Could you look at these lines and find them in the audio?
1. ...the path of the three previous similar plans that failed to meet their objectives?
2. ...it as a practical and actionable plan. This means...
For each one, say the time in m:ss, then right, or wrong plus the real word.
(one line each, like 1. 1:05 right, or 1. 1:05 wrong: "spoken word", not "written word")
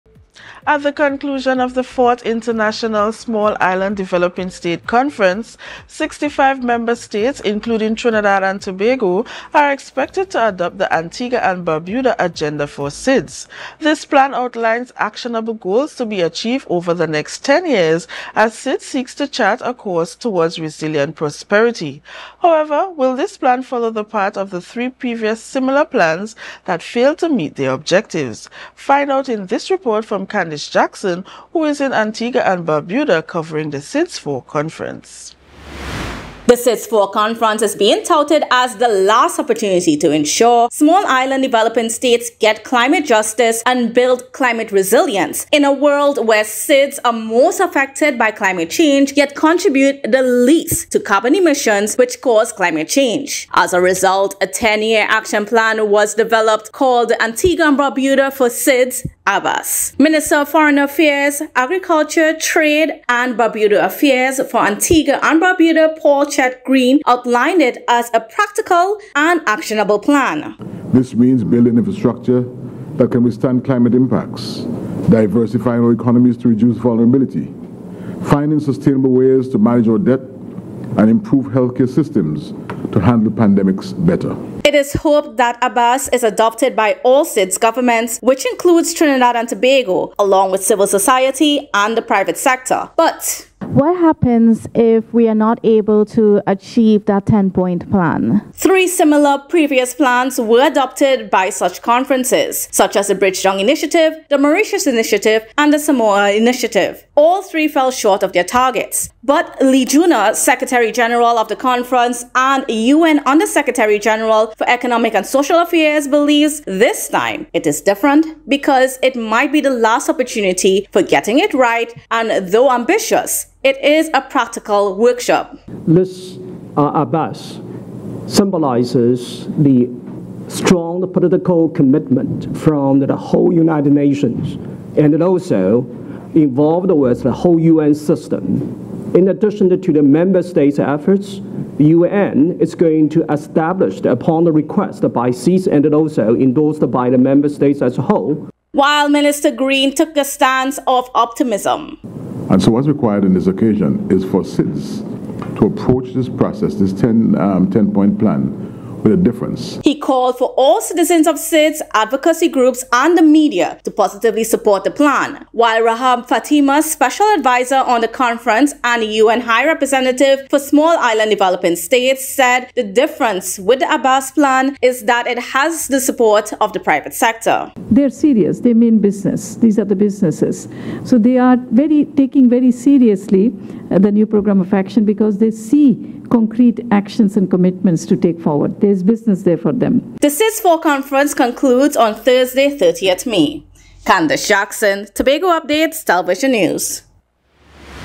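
1. 0:23 right
2. 1:07 right.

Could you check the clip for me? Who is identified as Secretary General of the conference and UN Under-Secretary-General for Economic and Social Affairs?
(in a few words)
Li Junhua.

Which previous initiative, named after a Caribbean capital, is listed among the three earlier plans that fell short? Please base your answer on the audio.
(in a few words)
Bridgetown Initiative.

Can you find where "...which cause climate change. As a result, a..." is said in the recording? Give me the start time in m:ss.
0:51.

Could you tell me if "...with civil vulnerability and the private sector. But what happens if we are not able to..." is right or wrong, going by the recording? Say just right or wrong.
wrong.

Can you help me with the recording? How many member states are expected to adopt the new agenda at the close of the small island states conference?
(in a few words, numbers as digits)
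65.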